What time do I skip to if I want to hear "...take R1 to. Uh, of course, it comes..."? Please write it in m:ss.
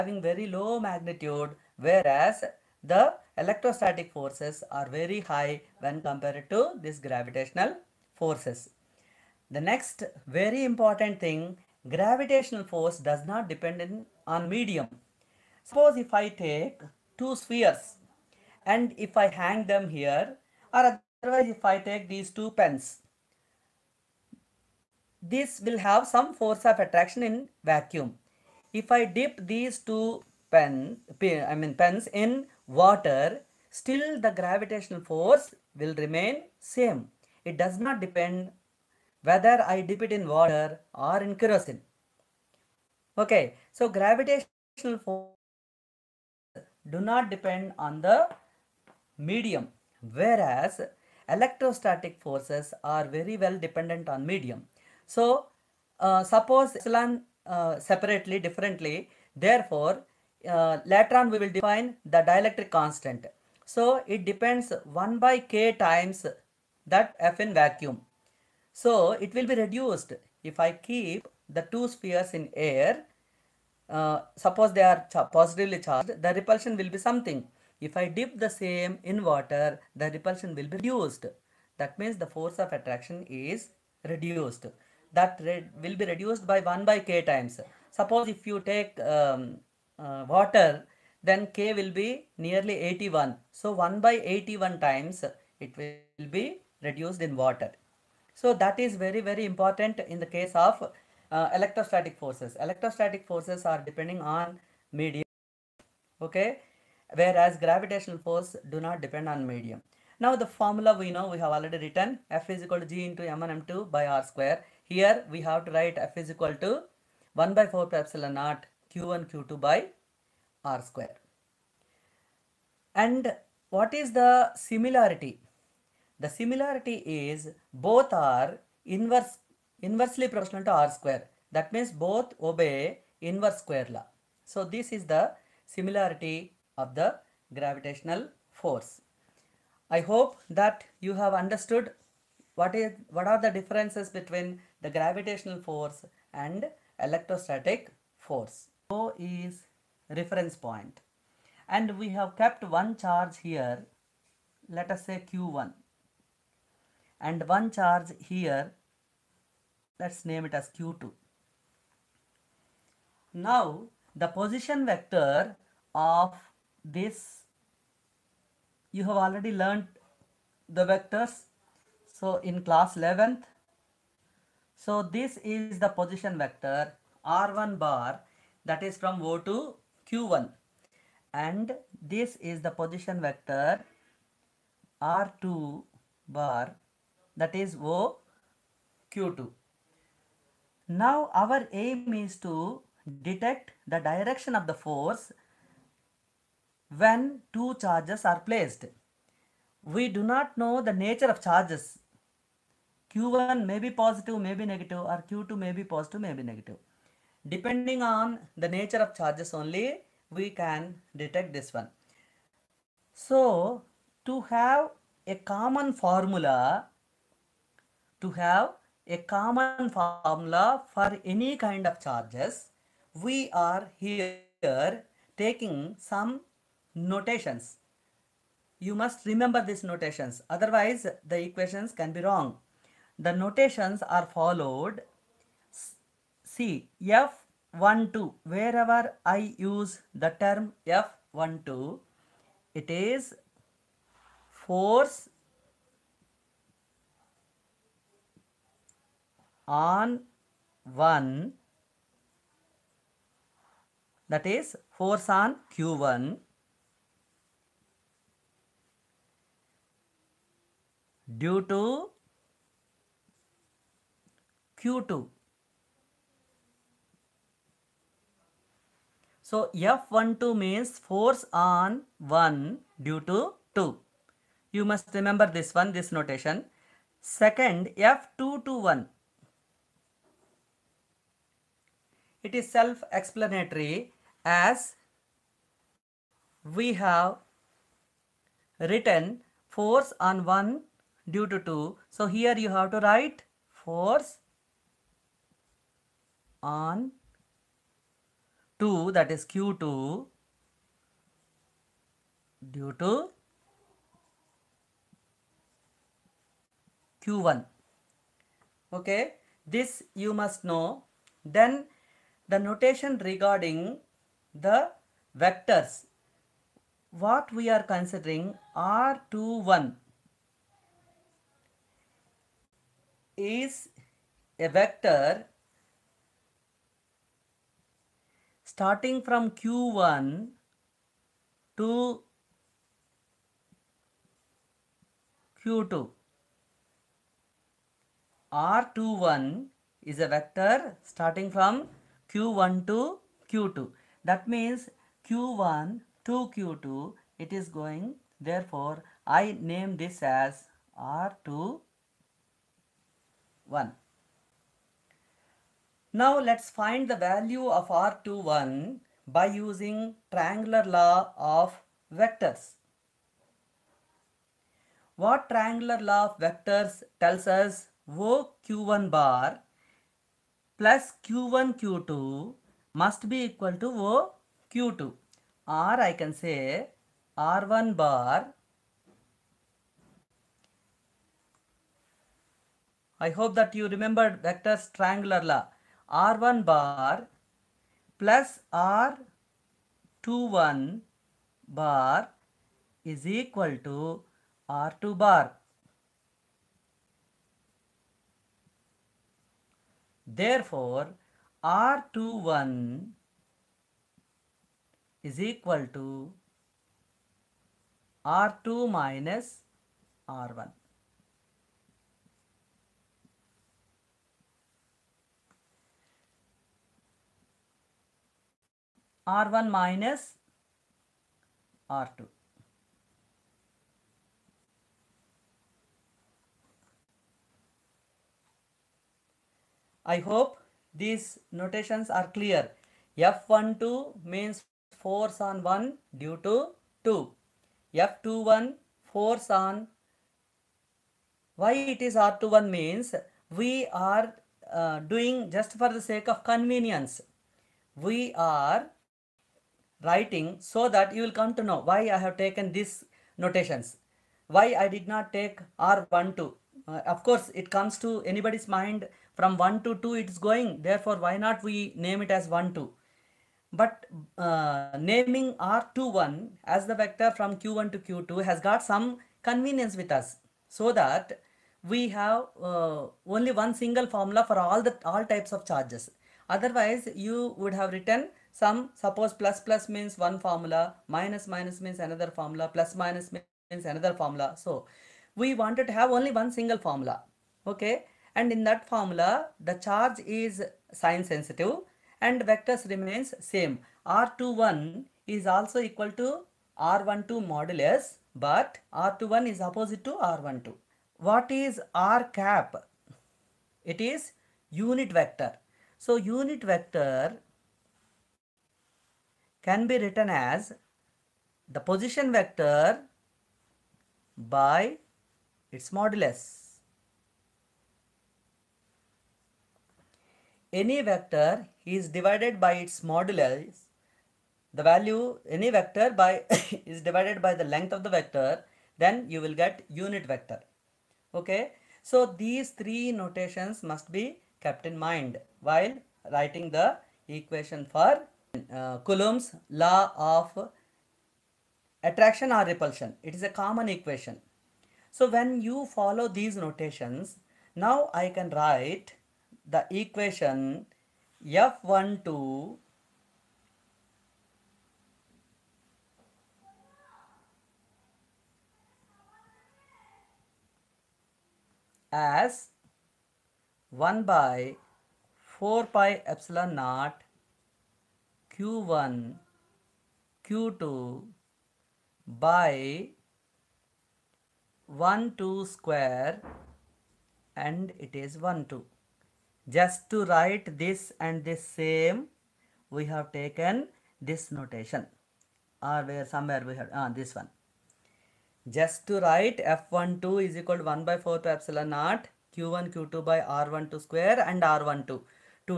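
7:35.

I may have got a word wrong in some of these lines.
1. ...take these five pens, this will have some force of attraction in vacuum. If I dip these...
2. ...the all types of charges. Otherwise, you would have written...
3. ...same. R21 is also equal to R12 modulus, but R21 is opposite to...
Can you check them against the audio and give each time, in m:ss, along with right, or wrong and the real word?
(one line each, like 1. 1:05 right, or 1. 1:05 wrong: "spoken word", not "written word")
1. 0:21 wrong: "two", not "five"
2. 7:54 right
3. 8:13 right.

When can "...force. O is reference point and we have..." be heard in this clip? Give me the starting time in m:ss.
2:28.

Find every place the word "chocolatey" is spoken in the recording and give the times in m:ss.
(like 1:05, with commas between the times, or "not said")
not said.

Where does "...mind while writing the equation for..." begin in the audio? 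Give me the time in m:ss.
8:54.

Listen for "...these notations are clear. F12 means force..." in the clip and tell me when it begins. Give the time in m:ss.
7:10.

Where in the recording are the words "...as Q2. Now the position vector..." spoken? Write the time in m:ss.
2:40.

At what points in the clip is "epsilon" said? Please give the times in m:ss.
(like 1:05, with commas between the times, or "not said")
0:56, 1:57, 9:26, 9:51.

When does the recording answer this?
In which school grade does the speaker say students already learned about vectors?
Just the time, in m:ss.
2:52.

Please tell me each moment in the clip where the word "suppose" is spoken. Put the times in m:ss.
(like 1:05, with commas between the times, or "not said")
0:15, 0:56, 1:14, 1:27, 7:58.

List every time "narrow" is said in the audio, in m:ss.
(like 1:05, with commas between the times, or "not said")
not said.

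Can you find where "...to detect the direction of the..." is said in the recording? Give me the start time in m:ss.
3:12.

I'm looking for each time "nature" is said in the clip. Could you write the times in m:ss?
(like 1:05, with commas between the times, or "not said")
3:20, 3:28.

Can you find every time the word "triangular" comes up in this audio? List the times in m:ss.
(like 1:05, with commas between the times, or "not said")
6:00, 6:05, 6:24.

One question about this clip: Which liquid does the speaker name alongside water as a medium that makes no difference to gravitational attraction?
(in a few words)
kerosene.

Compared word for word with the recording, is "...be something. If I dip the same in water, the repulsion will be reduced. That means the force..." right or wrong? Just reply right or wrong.
right.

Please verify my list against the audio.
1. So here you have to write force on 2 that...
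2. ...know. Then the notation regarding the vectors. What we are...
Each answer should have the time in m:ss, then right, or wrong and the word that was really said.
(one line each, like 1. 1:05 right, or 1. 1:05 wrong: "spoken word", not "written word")
1. 4:52 right
2. 5:10 right.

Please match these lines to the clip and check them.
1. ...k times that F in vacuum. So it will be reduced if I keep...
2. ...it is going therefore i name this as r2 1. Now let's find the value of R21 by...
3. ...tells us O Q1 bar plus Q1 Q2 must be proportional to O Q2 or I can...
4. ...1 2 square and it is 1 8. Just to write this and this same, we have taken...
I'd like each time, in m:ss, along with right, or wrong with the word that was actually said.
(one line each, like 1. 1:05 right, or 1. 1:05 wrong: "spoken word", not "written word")
1. 1:05 right
2. 5:47 right
3. 6:07 wrong: "equal", not "proportional"
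4. 9:34 wrong: "2", not "8".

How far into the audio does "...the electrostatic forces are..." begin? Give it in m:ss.
0:02.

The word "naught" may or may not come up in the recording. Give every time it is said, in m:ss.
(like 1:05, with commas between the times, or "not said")
1:58, 9:26, 9:51.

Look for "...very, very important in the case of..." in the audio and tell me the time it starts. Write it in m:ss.
1:38.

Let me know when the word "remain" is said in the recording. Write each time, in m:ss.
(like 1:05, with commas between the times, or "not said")
0:35, 8:12.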